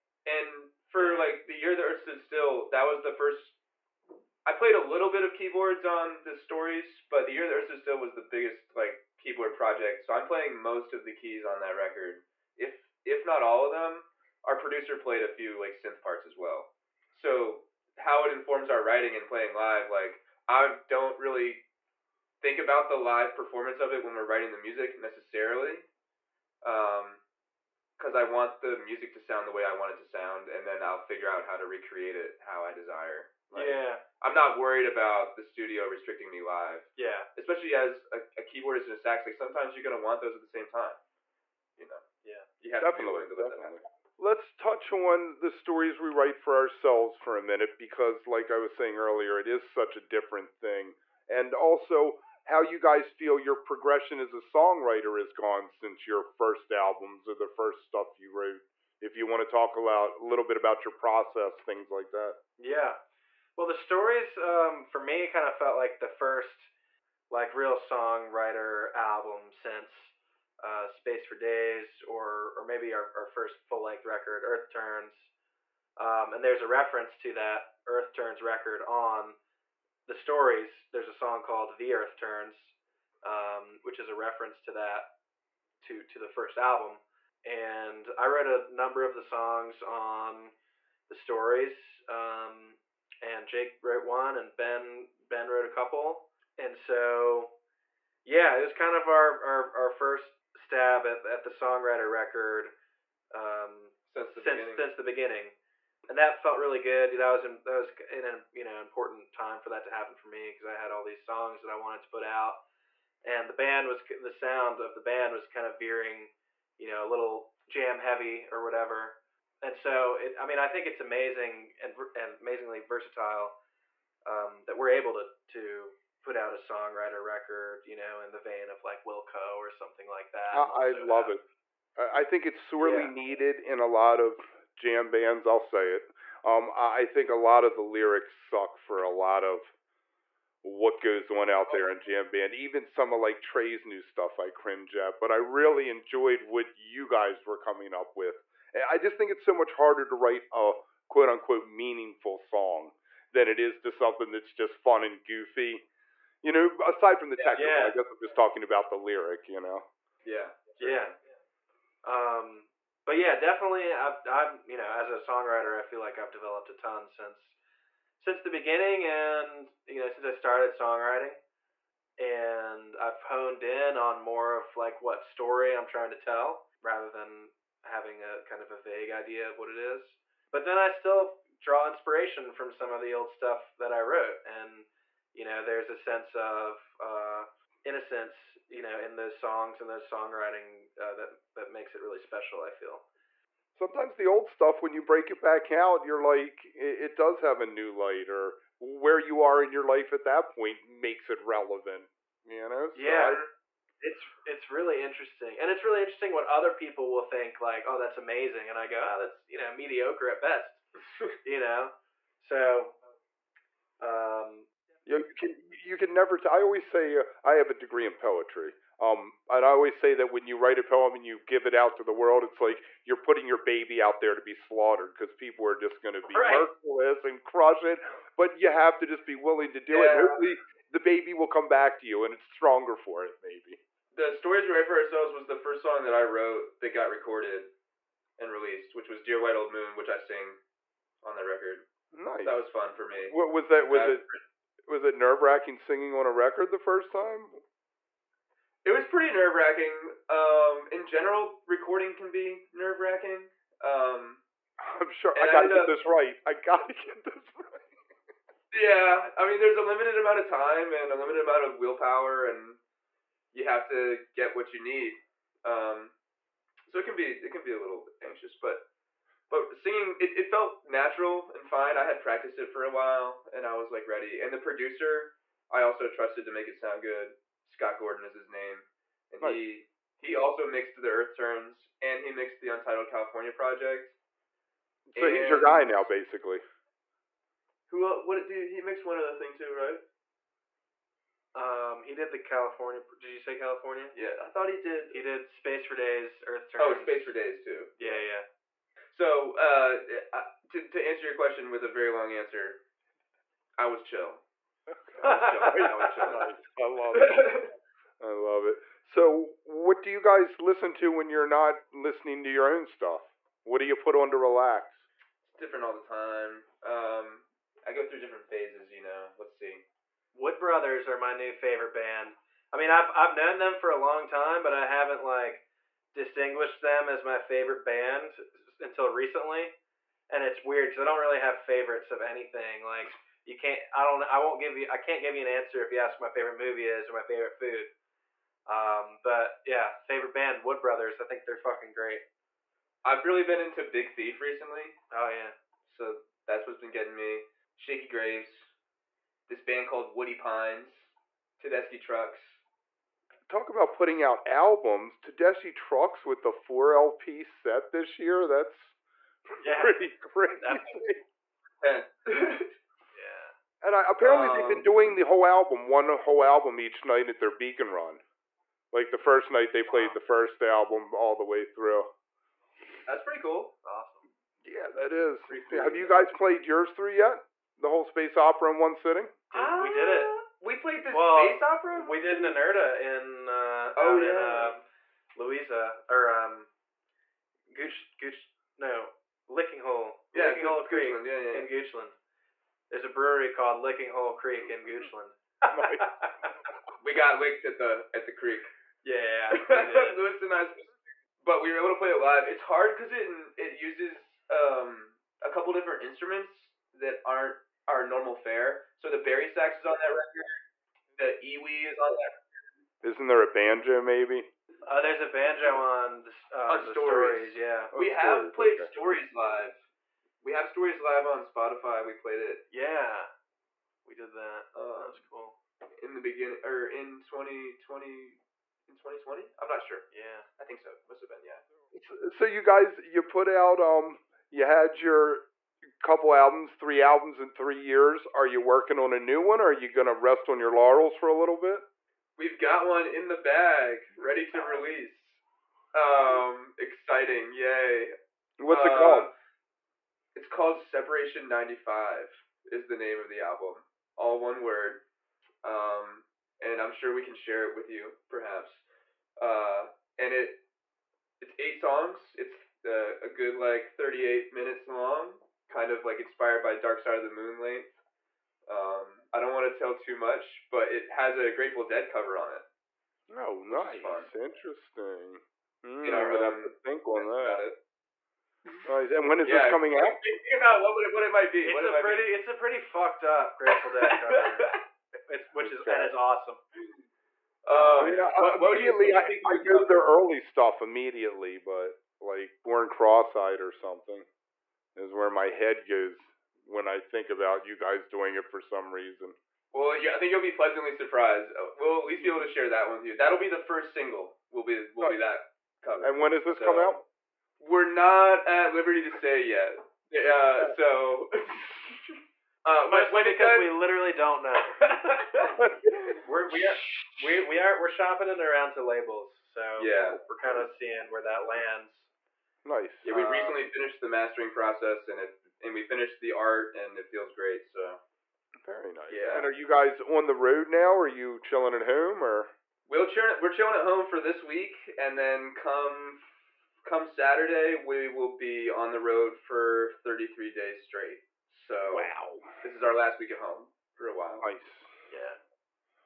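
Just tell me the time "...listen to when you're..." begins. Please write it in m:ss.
5:10.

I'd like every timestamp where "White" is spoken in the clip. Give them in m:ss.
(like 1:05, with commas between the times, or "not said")
3:59.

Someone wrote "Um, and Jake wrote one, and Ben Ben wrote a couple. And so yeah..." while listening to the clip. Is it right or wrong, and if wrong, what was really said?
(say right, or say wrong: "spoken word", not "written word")
right.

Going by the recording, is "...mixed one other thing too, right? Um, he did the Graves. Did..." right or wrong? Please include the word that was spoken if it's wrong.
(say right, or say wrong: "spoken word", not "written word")
wrong: "California", not "Graves".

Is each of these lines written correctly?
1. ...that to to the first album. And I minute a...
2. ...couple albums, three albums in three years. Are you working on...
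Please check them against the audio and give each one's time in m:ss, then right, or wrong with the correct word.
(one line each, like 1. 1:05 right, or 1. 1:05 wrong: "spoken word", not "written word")
1. 1:24 wrong: "wrote", not "minute"
2. 7:16 right.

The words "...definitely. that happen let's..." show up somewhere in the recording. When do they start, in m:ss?
0:43.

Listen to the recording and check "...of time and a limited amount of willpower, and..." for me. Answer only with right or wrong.
right.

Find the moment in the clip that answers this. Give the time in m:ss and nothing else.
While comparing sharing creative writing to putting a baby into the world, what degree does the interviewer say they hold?
3:38.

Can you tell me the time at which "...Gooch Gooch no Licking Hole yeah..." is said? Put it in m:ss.
6:27.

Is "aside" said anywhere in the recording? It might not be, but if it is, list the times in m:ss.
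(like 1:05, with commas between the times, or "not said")
2:36.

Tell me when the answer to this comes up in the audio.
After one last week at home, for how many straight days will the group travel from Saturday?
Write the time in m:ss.
9:00.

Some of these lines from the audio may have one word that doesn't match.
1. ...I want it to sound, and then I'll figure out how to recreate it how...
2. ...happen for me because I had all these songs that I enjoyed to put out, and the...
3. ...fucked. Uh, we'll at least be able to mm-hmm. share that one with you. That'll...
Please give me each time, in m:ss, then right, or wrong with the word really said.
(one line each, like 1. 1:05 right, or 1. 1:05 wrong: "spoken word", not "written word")
1. 0:29 right
2. 1:49 wrong: "wanted", not "enjoyed"
3. 8:20 wrong: "surprised", not "fucked".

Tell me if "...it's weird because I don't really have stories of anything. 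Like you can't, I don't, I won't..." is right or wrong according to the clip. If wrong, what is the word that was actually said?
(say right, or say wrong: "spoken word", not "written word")
wrong: "favorites", not "stories".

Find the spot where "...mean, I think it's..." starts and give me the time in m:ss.
2:00.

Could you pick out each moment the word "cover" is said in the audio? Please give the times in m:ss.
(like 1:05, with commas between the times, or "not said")
7:52, 8:04, 8:25.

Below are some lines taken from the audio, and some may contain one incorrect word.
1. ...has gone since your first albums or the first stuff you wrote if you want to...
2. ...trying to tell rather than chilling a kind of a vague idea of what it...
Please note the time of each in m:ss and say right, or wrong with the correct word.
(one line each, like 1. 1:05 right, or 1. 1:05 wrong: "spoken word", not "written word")
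1. 0:55 right
2. 2:55 wrong: "having", not "chilling".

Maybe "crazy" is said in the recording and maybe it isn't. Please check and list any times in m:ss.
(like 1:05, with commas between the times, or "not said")
6:00.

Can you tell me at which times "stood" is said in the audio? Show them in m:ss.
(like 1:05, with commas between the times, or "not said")
0:01, 0:07.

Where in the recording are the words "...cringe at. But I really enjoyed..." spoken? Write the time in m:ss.
2:24.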